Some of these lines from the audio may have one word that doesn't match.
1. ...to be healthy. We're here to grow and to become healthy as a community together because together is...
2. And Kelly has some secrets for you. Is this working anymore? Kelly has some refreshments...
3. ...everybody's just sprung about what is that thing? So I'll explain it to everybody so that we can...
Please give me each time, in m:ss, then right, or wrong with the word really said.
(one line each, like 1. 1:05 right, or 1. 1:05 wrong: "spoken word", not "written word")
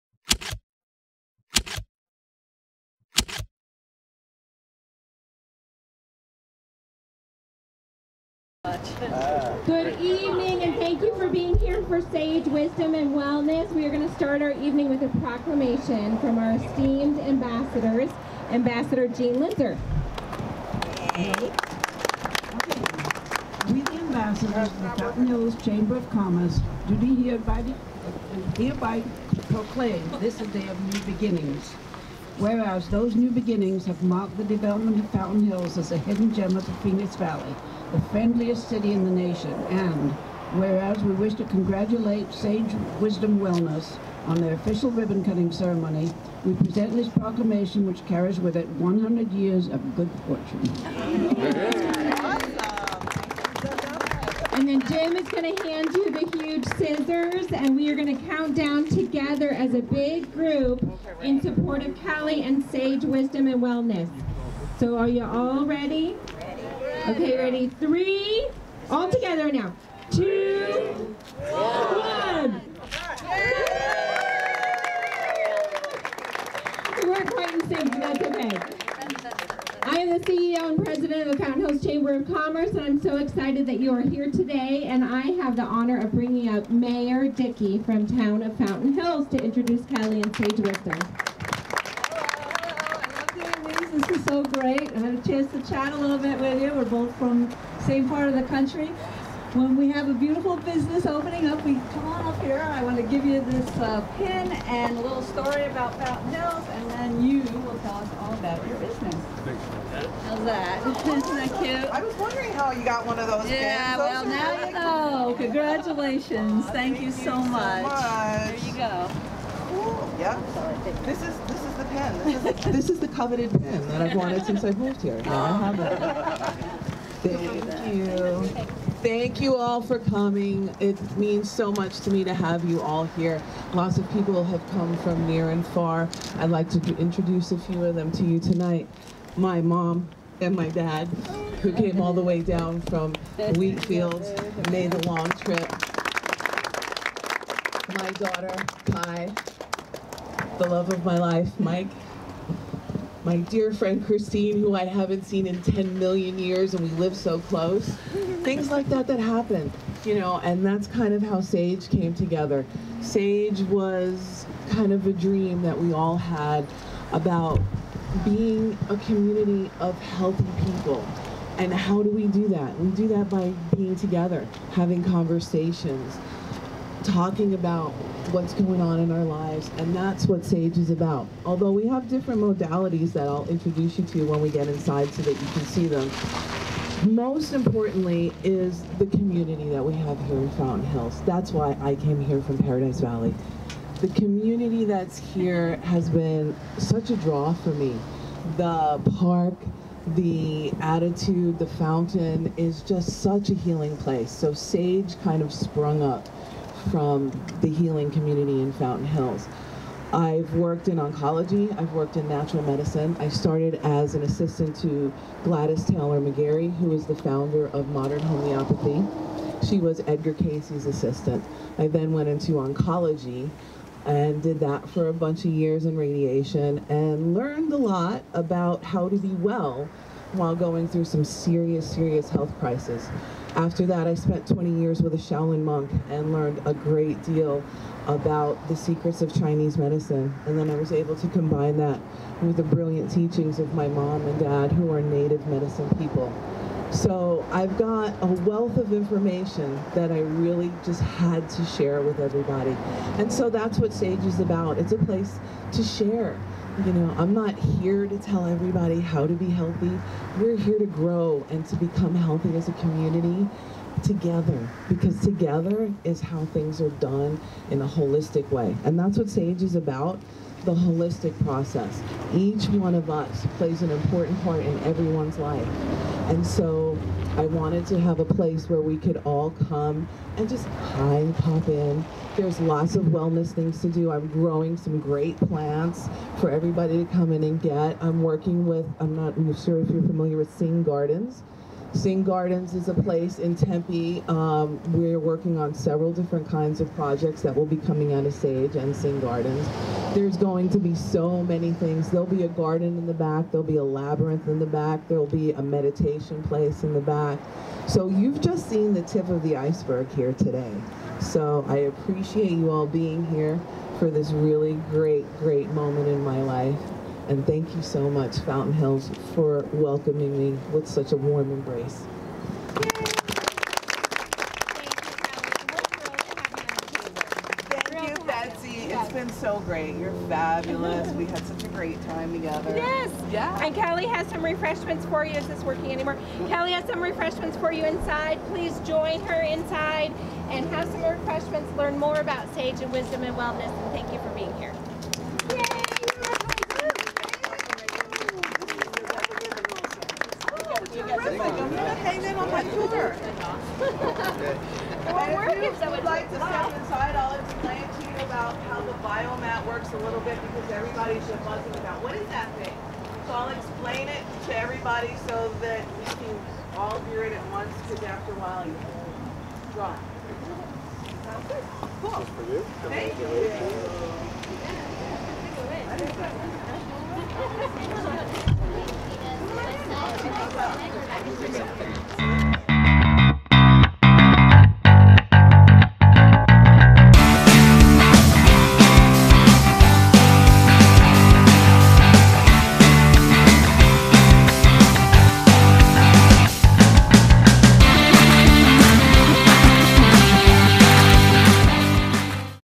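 1. 4:19 right
2. 5:33 wrong: "refreshments", not "secrets"
3. 6:00 wrong: "buzzing", not "sprung".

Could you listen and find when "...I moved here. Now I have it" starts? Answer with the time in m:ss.
2:04.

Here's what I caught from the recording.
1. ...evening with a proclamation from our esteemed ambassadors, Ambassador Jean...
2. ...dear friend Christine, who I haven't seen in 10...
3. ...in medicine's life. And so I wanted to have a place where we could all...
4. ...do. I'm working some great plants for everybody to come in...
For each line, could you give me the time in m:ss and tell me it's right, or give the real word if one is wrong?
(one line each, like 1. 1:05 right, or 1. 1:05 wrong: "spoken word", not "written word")
1. 0:14 right
2. 2:33 right
3. 4:34 wrong: "everyone", not "medicine"
4. 4:43 wrong: "growing", not "working".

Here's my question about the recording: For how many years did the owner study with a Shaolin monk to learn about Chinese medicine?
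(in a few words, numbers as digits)
20.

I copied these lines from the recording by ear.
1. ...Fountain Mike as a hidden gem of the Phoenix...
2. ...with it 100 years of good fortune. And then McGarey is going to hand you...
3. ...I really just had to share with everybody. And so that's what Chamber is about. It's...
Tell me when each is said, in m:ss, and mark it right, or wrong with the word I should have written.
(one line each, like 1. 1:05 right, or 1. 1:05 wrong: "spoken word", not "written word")
1. 0:35 wrong: "Hills", not "Mike"
2. 0:48 wrong: "Jim", not "McGarey"
3. 4:10 wrong: "Sage", not "Chamber".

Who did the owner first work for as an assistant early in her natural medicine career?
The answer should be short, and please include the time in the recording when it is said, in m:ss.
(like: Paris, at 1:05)
Gladys Taylor McGarey, at 3:35.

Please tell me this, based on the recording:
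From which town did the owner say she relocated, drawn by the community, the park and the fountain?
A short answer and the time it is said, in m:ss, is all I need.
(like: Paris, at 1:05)
Paradise Valley, at 3:12.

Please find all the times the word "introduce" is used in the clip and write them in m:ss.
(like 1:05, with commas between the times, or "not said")
1:29, 2:16, 3:03.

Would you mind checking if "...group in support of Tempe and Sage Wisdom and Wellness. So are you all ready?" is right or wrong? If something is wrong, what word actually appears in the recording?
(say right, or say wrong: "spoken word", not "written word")
wrong: "Cali", not "Tempe".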